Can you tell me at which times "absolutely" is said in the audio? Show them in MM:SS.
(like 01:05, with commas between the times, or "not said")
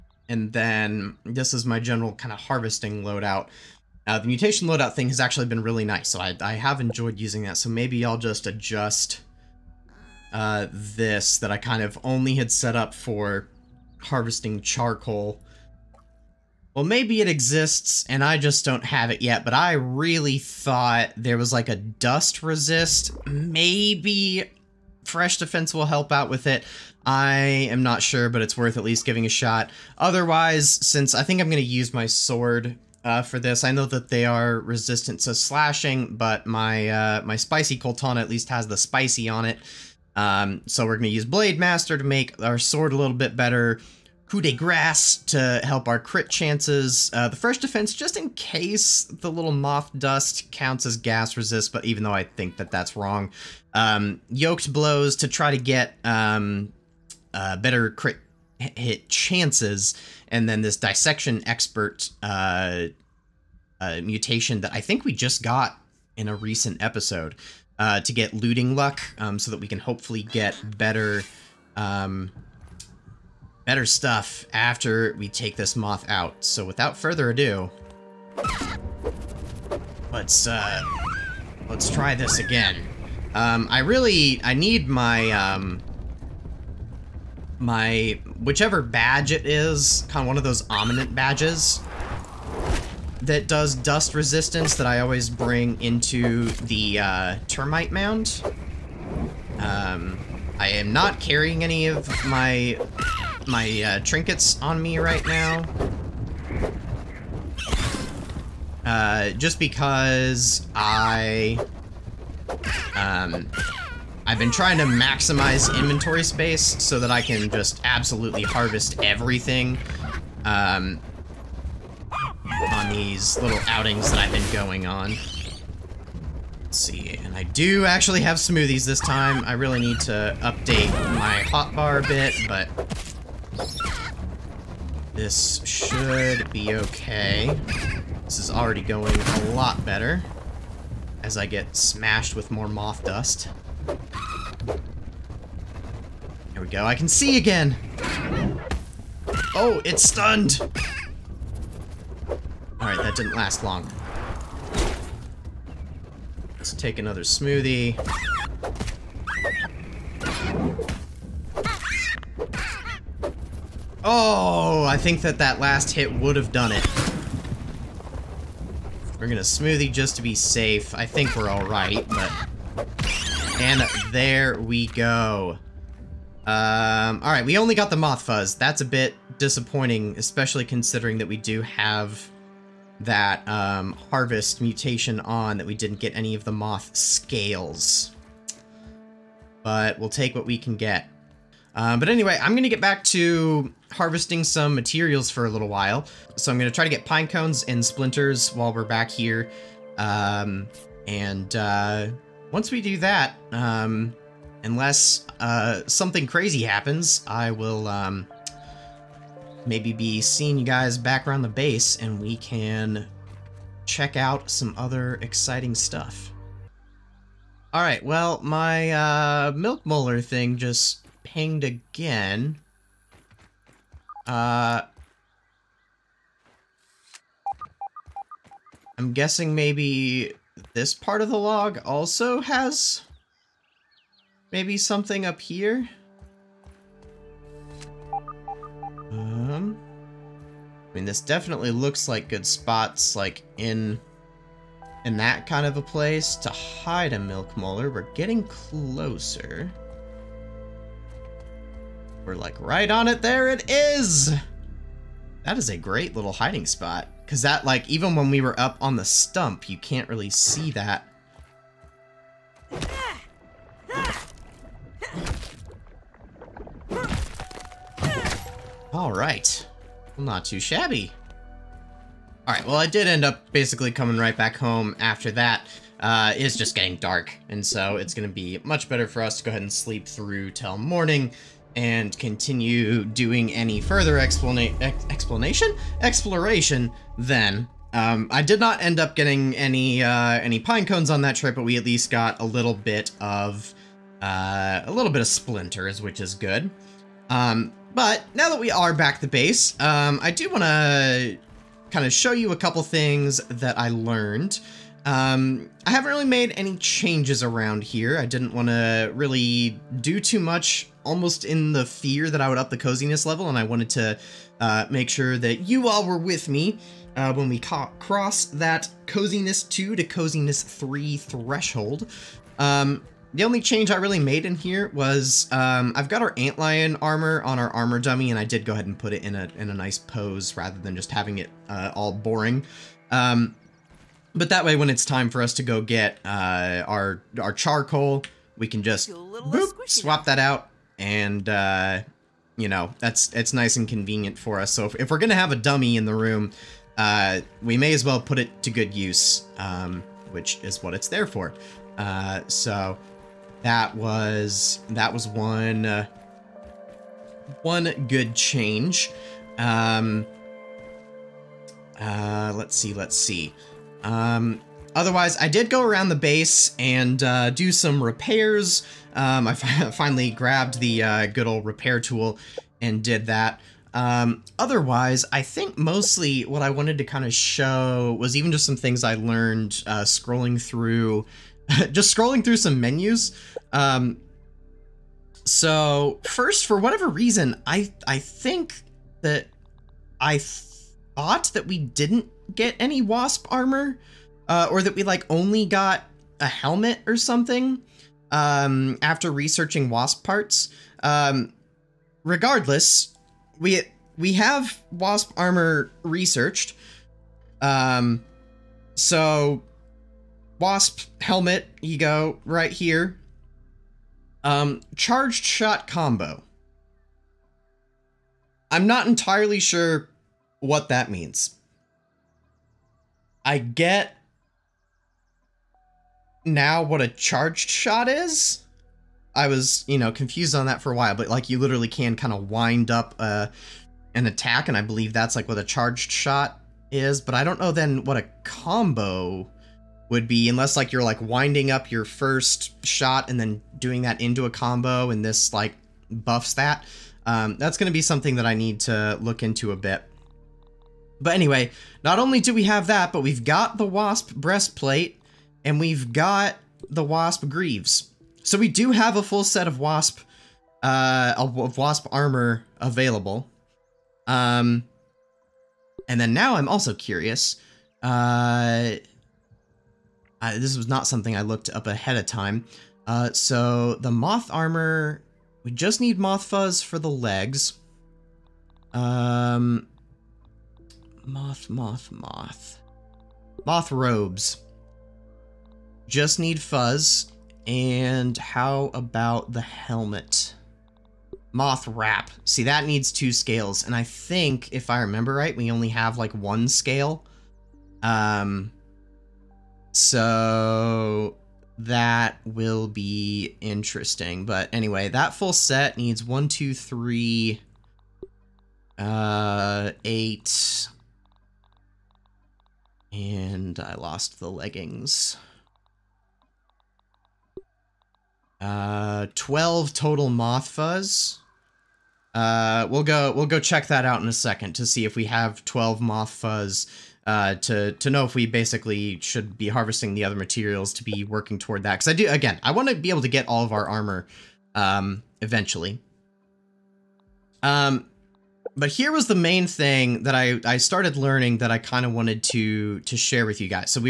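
01:57.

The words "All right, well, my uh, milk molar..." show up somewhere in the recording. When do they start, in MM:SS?
03:37.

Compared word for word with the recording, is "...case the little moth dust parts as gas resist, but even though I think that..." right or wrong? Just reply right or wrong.
wrong.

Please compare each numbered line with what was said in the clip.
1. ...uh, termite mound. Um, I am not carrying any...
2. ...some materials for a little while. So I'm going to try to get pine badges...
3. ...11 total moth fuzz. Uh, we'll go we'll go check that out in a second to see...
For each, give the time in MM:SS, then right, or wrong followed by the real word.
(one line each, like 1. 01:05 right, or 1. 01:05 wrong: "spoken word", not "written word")
1. 01:36 right
2. 03:14 wrong: "cones", not "badges"
3. 08:39 wrong: "12", not "11".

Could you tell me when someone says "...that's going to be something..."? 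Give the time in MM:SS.
07:27.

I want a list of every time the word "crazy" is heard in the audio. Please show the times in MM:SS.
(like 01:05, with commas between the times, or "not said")
03:26.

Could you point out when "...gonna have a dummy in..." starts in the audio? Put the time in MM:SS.
05:45.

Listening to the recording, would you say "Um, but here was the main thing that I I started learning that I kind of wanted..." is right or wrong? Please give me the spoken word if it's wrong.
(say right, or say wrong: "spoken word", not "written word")
right.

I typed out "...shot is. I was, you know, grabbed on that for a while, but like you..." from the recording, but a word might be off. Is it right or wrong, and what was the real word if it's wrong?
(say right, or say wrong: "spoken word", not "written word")
wrong: "confused", not "grabbed".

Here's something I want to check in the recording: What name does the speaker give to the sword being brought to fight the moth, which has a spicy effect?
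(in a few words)
Spicy Coaltana.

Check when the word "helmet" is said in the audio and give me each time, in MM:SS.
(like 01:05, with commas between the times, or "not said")
06:36, 06:51, 08:09.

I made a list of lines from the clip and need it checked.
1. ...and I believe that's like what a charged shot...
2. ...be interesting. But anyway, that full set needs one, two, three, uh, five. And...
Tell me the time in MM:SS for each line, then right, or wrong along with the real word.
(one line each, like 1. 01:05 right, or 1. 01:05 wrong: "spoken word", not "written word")
1. 07:14 right
2. 08:22 wrong: "eight", not "five".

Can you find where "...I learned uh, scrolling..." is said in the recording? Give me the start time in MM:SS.
06:19.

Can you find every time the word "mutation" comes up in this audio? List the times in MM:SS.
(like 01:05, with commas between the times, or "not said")
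00:04, 01:04, 03:04.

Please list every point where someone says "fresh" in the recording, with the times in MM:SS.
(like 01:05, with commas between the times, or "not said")
00:25, 00:47.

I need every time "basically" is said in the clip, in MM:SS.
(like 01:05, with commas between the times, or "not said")
04:33, 08:48.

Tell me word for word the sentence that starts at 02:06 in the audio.
Let's see, and I do actually have smoothies this time.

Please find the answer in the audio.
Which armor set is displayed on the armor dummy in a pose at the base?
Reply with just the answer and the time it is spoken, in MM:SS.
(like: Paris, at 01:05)
Antlion armor, at 05:26.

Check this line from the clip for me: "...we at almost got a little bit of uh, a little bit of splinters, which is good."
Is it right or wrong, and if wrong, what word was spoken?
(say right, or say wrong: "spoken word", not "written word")
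wrong: "least", not "almost".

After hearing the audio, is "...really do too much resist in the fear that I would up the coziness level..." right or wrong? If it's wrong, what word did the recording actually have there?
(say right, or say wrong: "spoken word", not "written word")
wrong: "almost", not "resist".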